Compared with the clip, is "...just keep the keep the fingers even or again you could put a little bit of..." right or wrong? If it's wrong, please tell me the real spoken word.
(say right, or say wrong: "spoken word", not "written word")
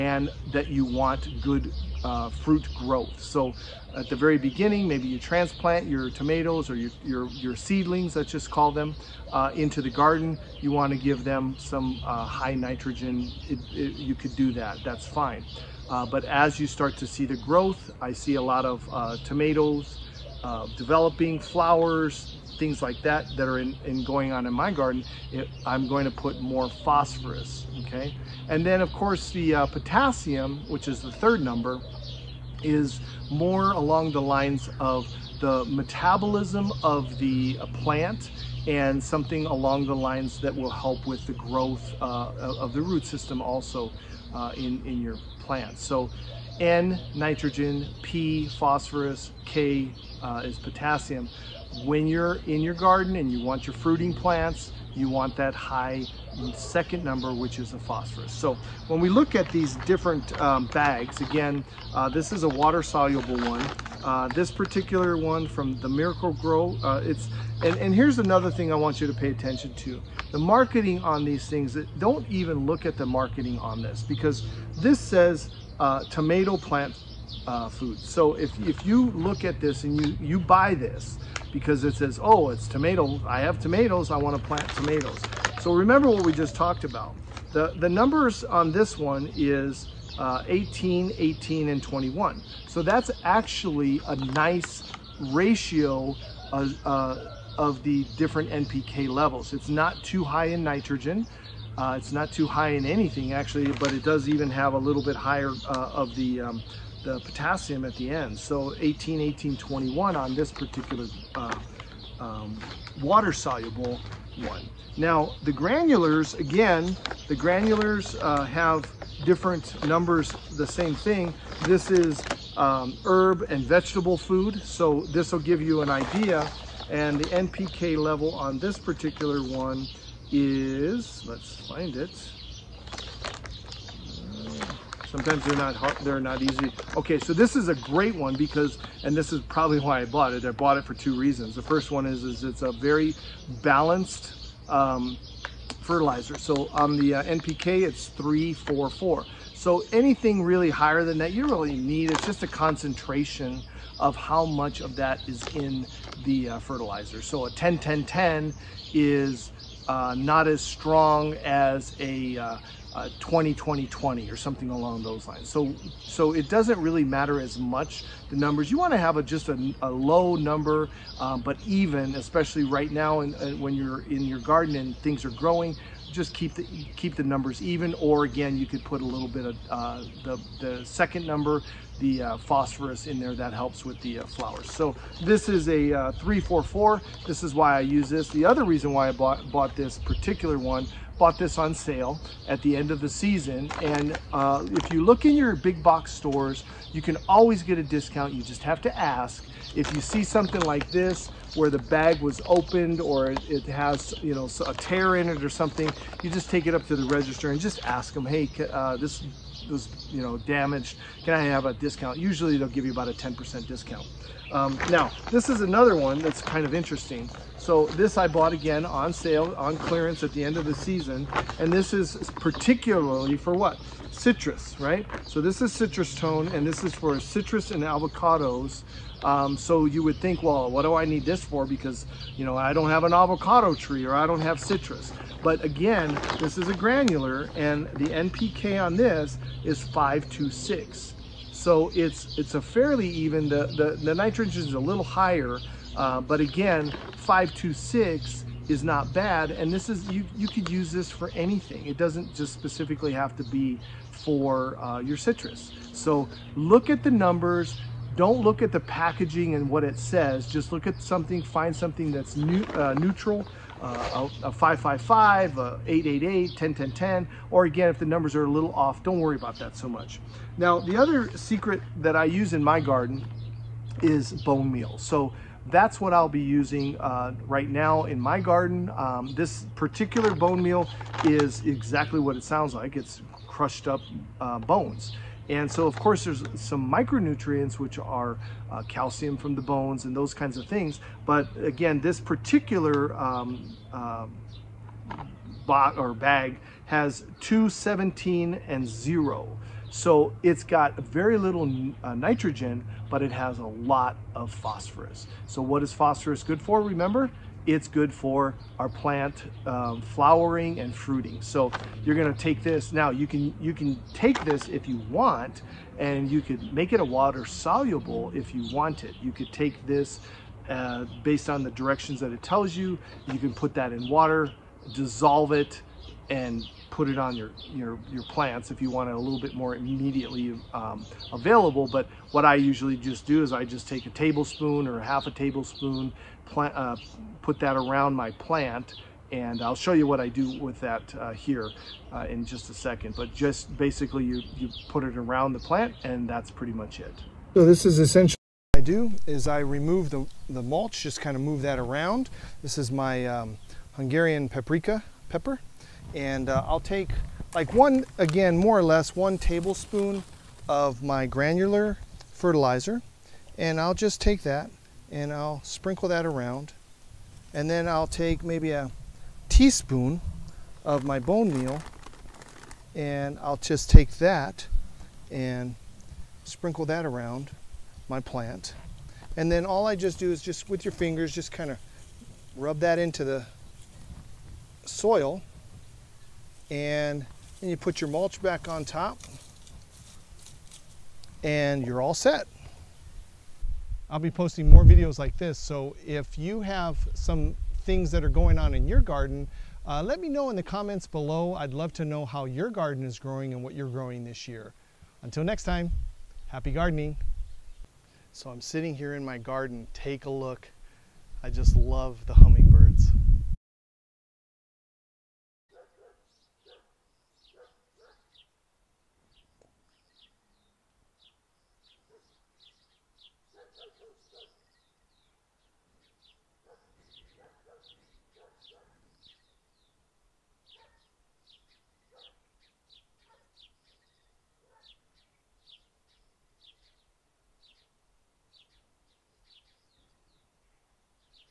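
wrong: "numbers", not "fingers".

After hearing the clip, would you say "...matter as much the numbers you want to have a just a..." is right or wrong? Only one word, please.
right.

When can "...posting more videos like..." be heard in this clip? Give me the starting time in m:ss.
6:34.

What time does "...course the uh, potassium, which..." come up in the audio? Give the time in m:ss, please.
0:28.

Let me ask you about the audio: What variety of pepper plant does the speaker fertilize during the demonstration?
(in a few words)
Hungarian paprika.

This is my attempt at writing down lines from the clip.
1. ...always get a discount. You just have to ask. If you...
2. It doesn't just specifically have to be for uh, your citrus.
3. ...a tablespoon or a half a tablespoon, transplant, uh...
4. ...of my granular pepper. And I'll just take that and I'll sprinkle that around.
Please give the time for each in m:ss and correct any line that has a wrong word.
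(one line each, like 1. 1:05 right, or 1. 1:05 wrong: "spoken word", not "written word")
1. 3:17 right
2. 4:11 right
3. 5:34 wrong: "plant", not "transplant"
4. 6:00 wrong: "fertilizer", not "pepper".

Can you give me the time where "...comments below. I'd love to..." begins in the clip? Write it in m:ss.
6:40.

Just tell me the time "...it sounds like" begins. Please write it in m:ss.
4:42.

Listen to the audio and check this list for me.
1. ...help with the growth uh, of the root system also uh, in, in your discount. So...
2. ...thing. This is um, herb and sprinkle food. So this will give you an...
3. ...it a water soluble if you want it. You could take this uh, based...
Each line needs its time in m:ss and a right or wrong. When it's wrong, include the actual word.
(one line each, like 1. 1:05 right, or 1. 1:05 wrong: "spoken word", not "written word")
1. 0:40 wrong: "plant", not "discount"
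2. 2:00 wrong: "vegetable", not "sprinkle"
3. 5:16 right.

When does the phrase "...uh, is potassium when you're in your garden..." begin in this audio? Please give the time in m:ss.
0:50.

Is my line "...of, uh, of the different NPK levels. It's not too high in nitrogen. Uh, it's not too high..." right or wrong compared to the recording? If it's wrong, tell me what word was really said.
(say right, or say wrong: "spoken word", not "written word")
right.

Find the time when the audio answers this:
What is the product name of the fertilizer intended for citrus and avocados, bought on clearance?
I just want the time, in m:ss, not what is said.
3:45.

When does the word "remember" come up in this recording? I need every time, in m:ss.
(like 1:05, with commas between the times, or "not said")
1:25, 5:06.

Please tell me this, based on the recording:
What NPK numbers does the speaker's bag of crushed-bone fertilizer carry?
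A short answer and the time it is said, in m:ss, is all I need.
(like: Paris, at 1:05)
2-17-0, at 4:57.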